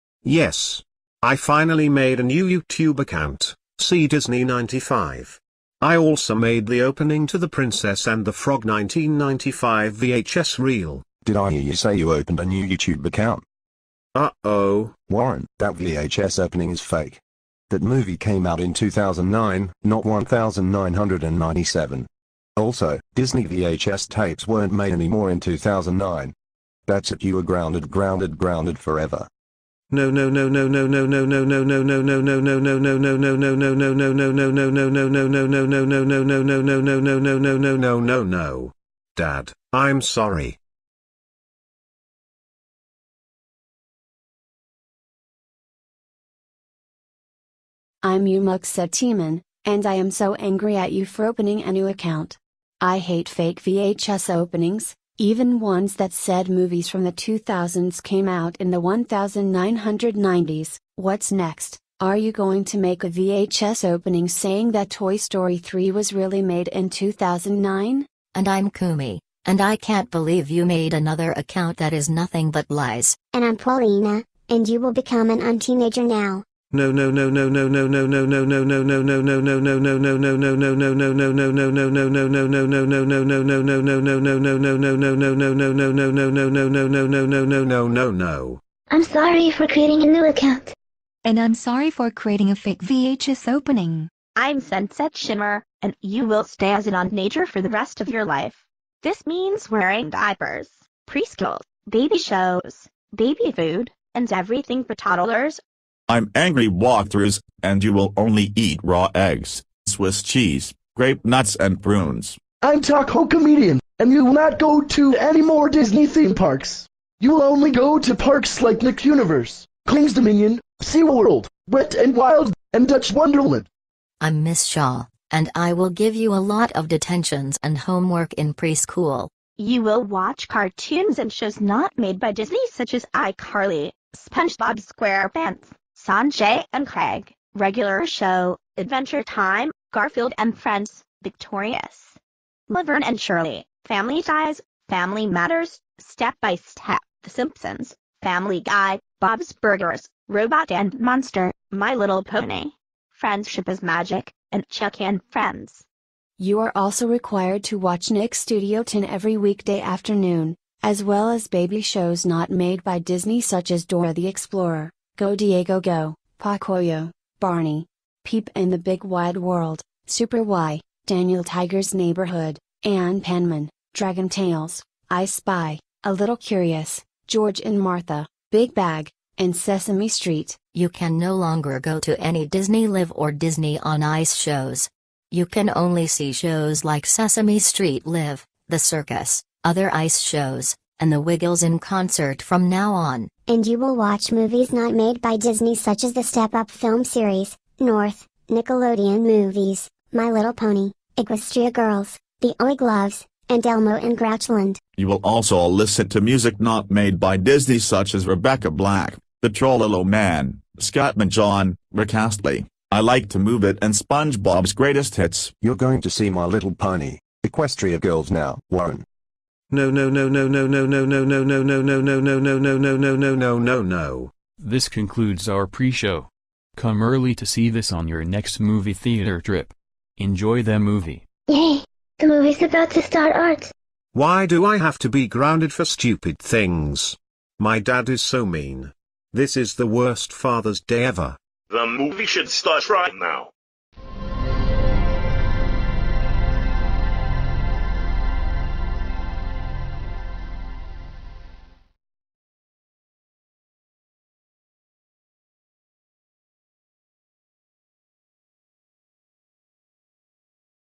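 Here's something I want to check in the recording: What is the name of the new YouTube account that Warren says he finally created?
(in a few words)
SeaDisney95.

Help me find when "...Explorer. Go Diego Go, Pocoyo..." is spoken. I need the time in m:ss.
2:44.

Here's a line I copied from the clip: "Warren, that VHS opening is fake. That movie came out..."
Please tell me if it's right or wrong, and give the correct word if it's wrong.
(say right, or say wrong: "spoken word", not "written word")
right.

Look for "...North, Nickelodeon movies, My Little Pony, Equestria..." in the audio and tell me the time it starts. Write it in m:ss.
3:17.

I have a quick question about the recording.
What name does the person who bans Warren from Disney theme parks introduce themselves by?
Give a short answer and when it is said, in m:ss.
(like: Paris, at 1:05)
Taco Comedian, at 1:52.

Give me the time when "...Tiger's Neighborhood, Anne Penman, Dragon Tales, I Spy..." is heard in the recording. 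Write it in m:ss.
2:51.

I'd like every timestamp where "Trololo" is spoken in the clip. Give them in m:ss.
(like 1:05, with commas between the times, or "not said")
3:29.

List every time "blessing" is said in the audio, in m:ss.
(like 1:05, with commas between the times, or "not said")
not said.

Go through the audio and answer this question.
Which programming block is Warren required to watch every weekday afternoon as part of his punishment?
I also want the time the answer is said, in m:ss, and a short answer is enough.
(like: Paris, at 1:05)
Nick Studio 10, at 2:38.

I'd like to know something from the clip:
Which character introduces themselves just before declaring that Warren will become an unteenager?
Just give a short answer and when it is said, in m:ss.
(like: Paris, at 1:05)
Paulina, at 1:13.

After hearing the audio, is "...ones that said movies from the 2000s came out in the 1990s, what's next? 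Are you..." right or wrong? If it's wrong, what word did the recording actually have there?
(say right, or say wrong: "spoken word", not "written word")
right.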